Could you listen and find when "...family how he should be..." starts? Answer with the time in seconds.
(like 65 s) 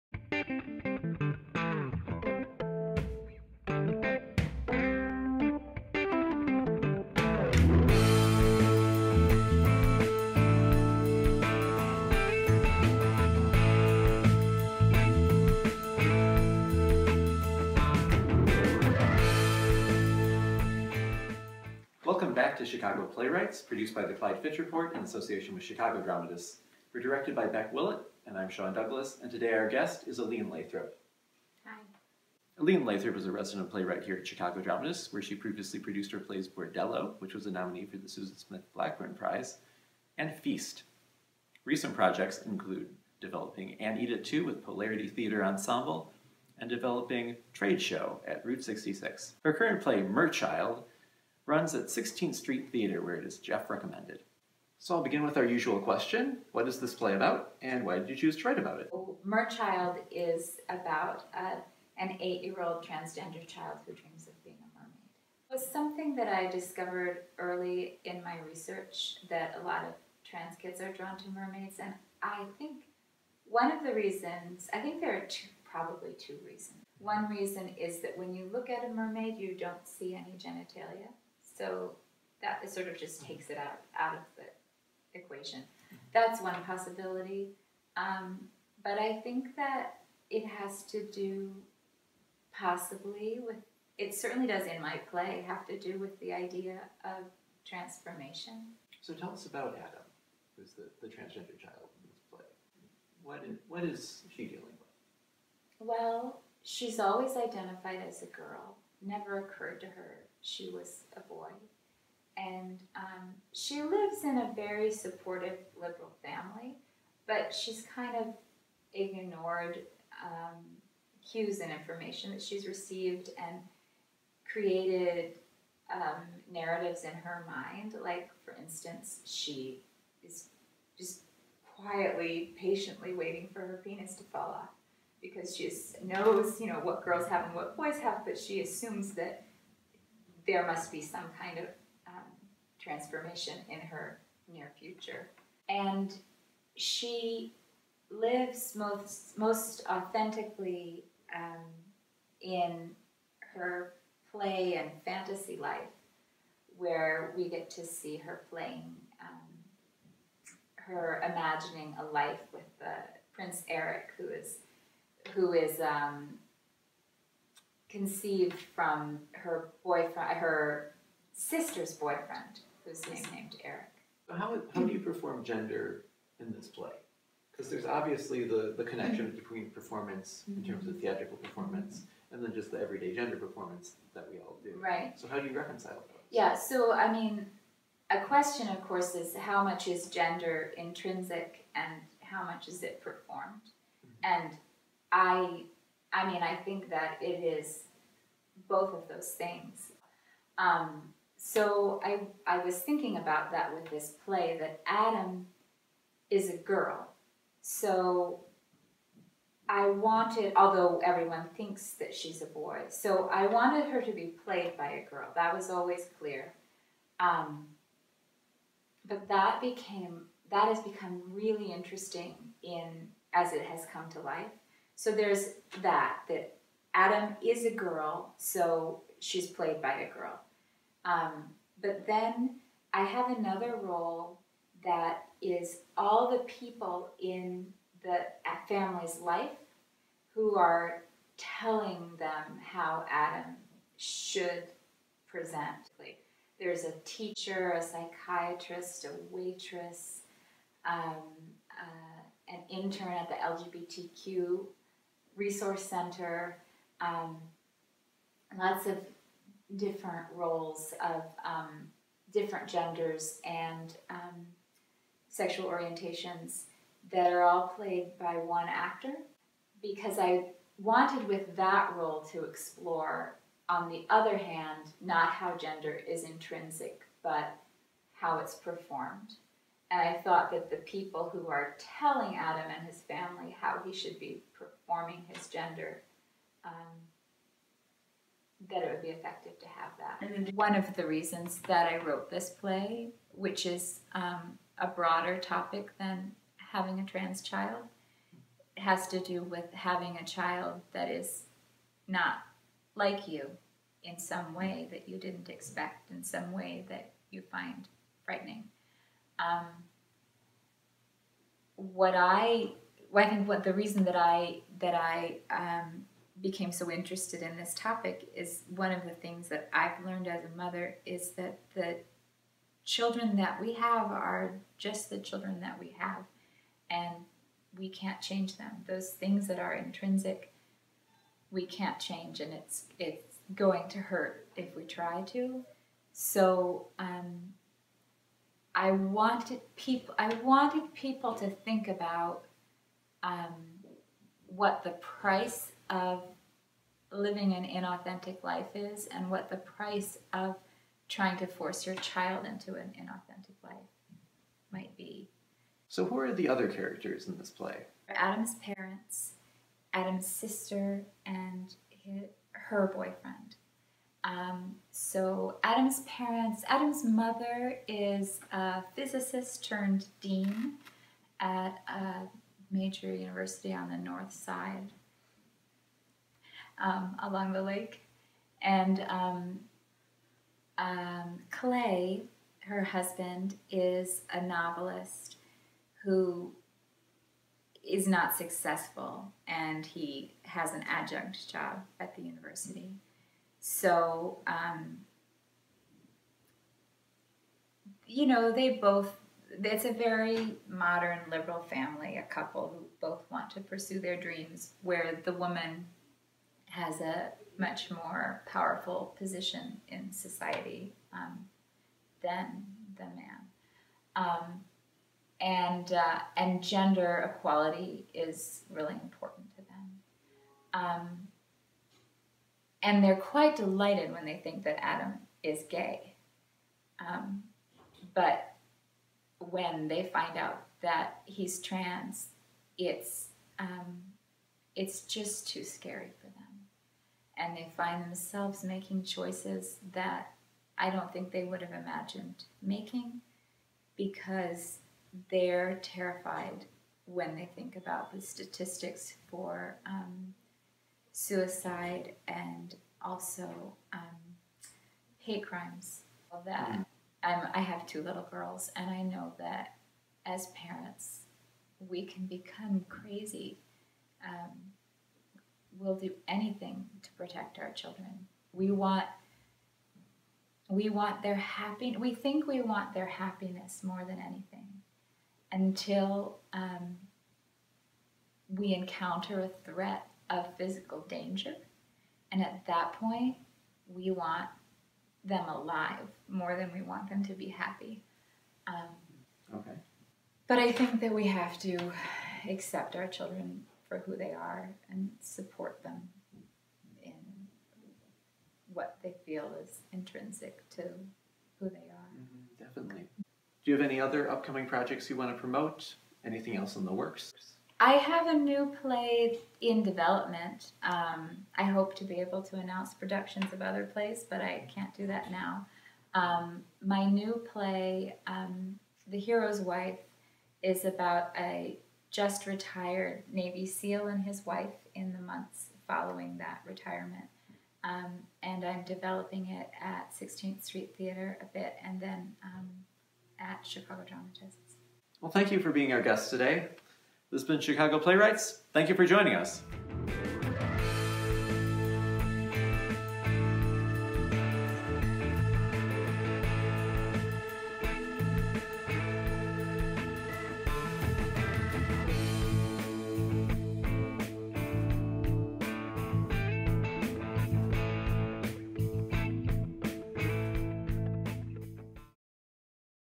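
283 s.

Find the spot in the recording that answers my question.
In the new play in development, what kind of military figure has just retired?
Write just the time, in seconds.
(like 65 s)
523 s.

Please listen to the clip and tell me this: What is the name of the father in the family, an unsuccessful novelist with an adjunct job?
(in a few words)
Clay.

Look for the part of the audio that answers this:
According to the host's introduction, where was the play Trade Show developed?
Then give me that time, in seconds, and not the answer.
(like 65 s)
48 s.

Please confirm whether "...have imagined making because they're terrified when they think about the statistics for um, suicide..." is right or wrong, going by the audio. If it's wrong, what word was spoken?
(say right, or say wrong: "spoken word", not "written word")
right.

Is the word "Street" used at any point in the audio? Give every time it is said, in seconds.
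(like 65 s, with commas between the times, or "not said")
52 s, 530 s.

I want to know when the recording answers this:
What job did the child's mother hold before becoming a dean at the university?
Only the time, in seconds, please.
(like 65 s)
368 s.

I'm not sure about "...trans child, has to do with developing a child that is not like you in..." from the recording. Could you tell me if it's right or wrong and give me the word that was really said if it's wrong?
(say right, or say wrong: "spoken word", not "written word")
wrong: "having", not "developing".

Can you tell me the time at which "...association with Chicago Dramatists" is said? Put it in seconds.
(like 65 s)
25 s.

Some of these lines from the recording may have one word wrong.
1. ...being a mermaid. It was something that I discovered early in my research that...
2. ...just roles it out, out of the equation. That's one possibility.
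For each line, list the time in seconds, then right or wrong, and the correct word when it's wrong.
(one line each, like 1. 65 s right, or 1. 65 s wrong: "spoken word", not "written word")
1. 64 s right
2. 82 s wrong: "takes", not "roles".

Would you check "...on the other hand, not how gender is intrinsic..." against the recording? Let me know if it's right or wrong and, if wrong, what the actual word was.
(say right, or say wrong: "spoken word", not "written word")
right.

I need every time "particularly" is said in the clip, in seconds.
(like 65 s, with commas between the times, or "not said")
not said.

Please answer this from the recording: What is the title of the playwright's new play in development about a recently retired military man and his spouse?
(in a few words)
The Hero's Wife.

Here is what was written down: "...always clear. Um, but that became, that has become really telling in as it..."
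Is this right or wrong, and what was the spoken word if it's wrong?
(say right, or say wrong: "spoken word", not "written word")
wrong: "interesting", not "telling".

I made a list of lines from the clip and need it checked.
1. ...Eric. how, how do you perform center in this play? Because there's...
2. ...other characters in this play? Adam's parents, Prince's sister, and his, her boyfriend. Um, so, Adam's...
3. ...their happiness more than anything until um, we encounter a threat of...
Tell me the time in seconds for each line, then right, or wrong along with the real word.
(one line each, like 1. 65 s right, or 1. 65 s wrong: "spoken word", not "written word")
1. 173 s wrong: "gender", not "center"
2. 356 s wrong: "Adam", not "Prince"
3. 472 s right.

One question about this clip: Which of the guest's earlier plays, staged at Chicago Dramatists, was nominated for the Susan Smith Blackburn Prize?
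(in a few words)
Bordello.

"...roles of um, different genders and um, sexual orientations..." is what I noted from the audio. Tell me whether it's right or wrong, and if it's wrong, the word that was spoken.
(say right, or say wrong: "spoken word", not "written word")
right.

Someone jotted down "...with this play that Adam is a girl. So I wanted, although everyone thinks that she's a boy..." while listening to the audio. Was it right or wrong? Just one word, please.
right.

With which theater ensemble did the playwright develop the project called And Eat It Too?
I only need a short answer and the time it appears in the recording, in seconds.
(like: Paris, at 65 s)
Polarity Theater Ensemble, at 44 s.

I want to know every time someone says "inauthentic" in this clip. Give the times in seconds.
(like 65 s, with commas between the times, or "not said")
347 s, 352 s.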